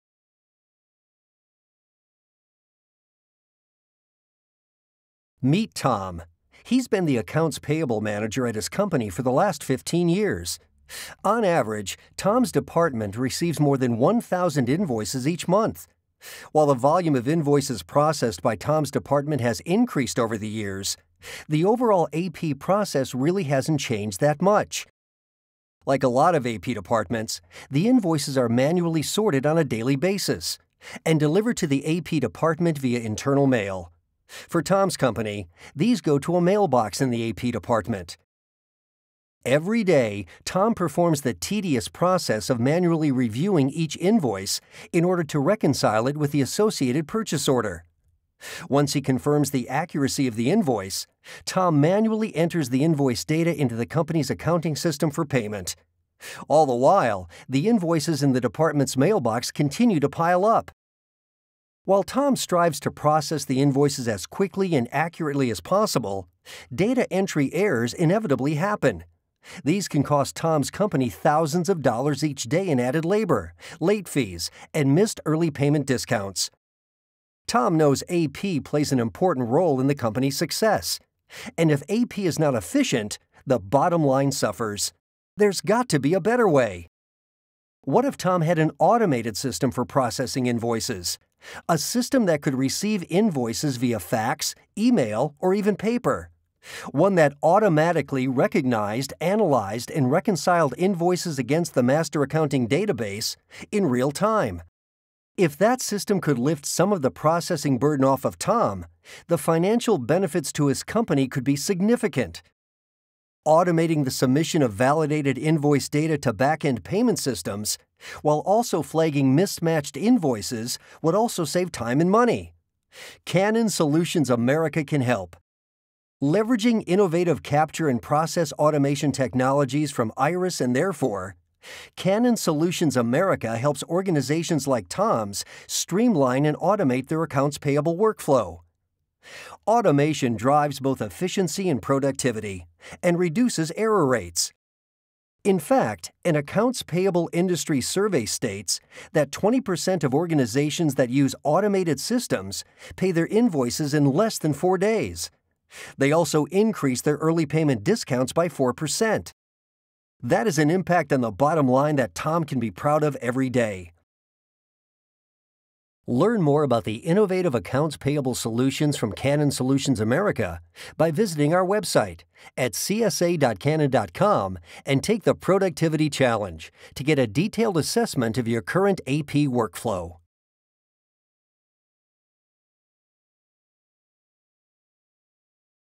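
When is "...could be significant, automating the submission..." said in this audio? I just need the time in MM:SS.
01:51.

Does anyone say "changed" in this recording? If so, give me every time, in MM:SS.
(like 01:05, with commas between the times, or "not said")
00:23.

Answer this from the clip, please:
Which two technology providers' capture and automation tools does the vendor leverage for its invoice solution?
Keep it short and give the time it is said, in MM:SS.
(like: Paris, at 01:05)
Iris and Therefore, at 02:10.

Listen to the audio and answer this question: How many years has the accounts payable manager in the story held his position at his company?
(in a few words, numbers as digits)
15.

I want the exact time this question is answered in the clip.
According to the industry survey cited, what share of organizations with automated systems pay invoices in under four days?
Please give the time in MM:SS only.
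02:29.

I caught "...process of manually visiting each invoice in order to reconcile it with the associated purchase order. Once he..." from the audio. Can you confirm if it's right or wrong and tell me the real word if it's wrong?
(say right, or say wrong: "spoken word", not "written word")
wrong: "reviewing", not "visiting".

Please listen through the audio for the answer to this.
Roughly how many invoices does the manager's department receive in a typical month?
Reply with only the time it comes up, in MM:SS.
00:13.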